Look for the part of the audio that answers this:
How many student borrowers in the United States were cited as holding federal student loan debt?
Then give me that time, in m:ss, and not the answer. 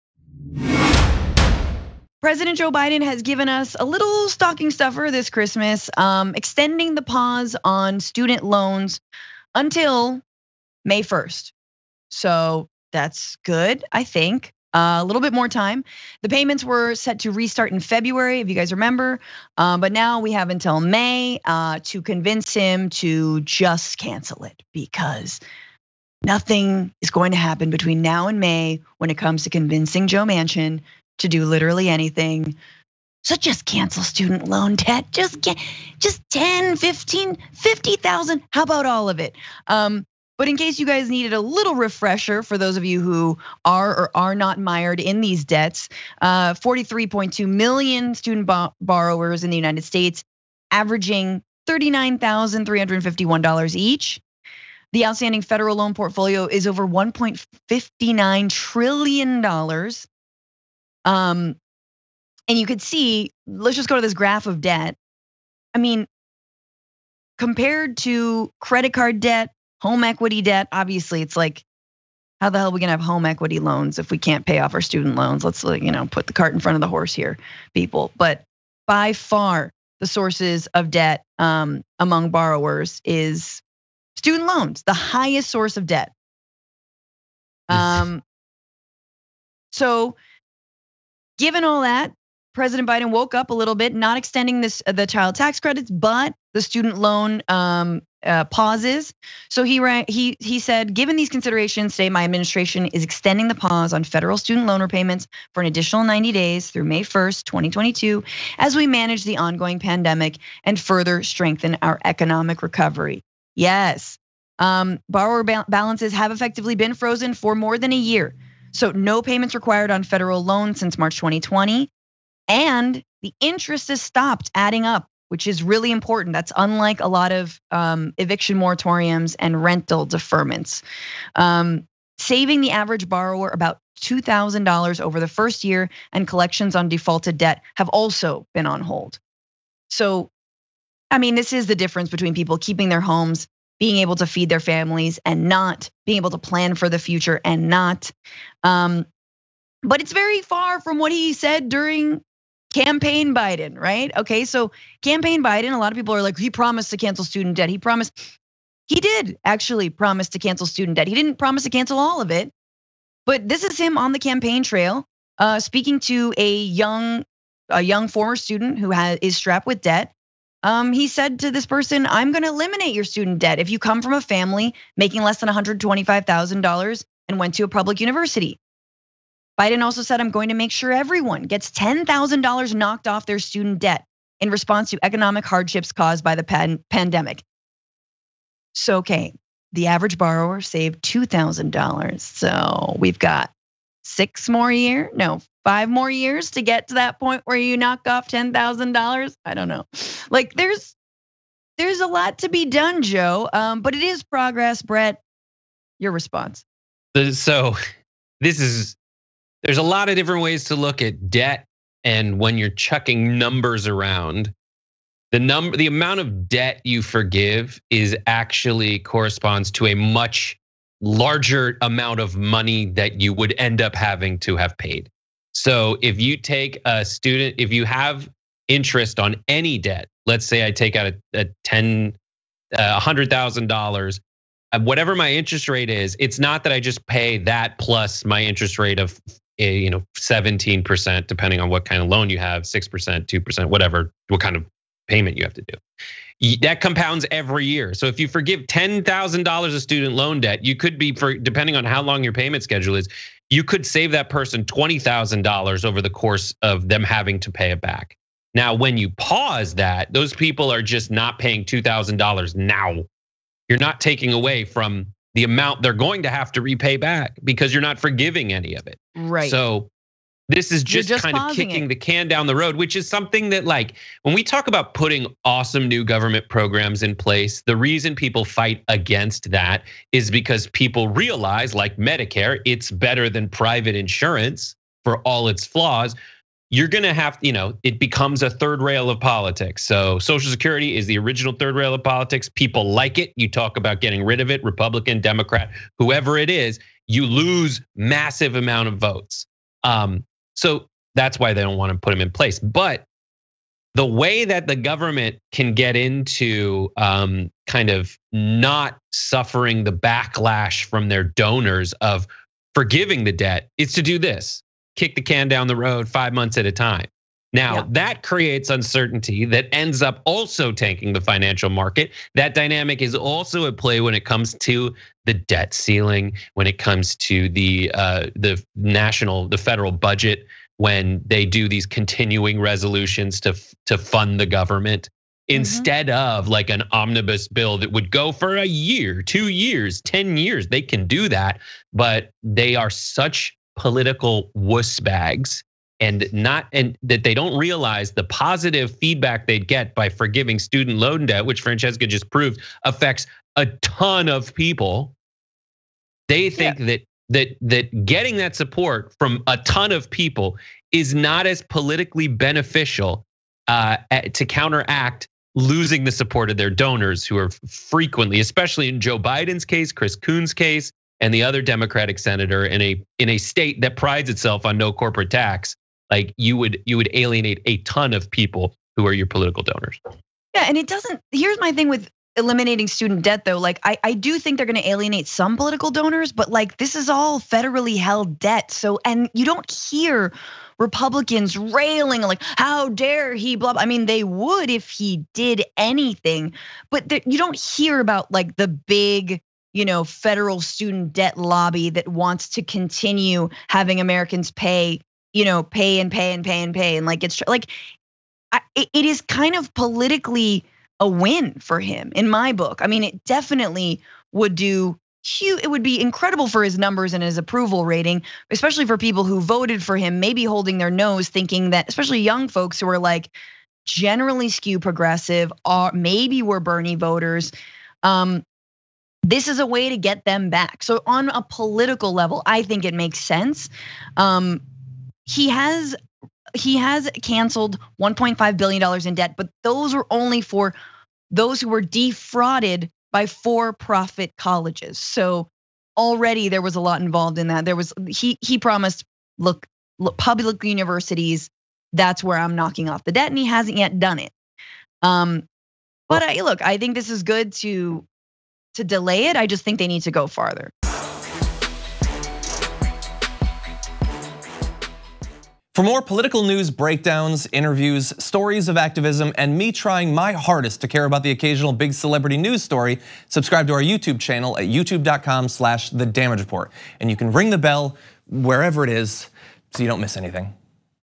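0:46.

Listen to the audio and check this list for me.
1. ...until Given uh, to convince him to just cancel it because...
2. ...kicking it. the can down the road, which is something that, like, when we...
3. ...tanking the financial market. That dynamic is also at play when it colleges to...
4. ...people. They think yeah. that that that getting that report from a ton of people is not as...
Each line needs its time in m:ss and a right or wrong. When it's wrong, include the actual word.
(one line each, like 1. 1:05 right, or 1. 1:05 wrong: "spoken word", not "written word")
1. 0:20 wrong: "May", not "Given"
2. 4:31 right
3. 5:20 wrong: "comes", not "colleges"
4. 5:54 wrong: "support", not "report".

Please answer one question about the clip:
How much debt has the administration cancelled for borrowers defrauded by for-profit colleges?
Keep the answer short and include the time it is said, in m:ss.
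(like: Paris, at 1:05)
1.5 billion dollars, at 7:18.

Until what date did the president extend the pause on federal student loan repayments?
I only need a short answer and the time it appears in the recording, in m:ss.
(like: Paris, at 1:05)
May 1st, 2022, at 1:46.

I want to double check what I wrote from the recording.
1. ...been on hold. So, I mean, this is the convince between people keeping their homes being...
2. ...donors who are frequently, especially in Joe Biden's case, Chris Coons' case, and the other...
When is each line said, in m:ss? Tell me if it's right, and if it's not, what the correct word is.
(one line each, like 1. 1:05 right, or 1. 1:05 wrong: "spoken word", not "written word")
1. 2:18 wrong: "difference", not "convince"
2. 6:06 right.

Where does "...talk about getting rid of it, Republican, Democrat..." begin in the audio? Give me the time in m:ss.
4:53.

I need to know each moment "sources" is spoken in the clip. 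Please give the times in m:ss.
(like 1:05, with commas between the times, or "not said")
1:20, 1:25.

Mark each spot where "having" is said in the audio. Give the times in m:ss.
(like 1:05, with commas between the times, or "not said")
3:43, 4:17, 6:43.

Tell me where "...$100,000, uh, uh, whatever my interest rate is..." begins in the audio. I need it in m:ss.
3:52.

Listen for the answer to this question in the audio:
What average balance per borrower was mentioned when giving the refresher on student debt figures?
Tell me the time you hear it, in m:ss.
0:51.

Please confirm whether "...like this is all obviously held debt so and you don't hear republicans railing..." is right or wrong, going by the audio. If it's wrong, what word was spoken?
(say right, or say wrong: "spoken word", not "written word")
wrong: "federally", not "obviously".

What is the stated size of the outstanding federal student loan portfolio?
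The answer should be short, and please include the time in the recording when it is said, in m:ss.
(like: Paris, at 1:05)
$1.59 trillion, at 0:56.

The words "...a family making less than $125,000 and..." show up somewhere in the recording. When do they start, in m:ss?
2:54.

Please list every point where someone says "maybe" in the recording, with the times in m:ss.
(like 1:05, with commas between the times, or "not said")
7:00, 7:05.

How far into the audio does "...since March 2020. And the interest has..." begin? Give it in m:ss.
2:00.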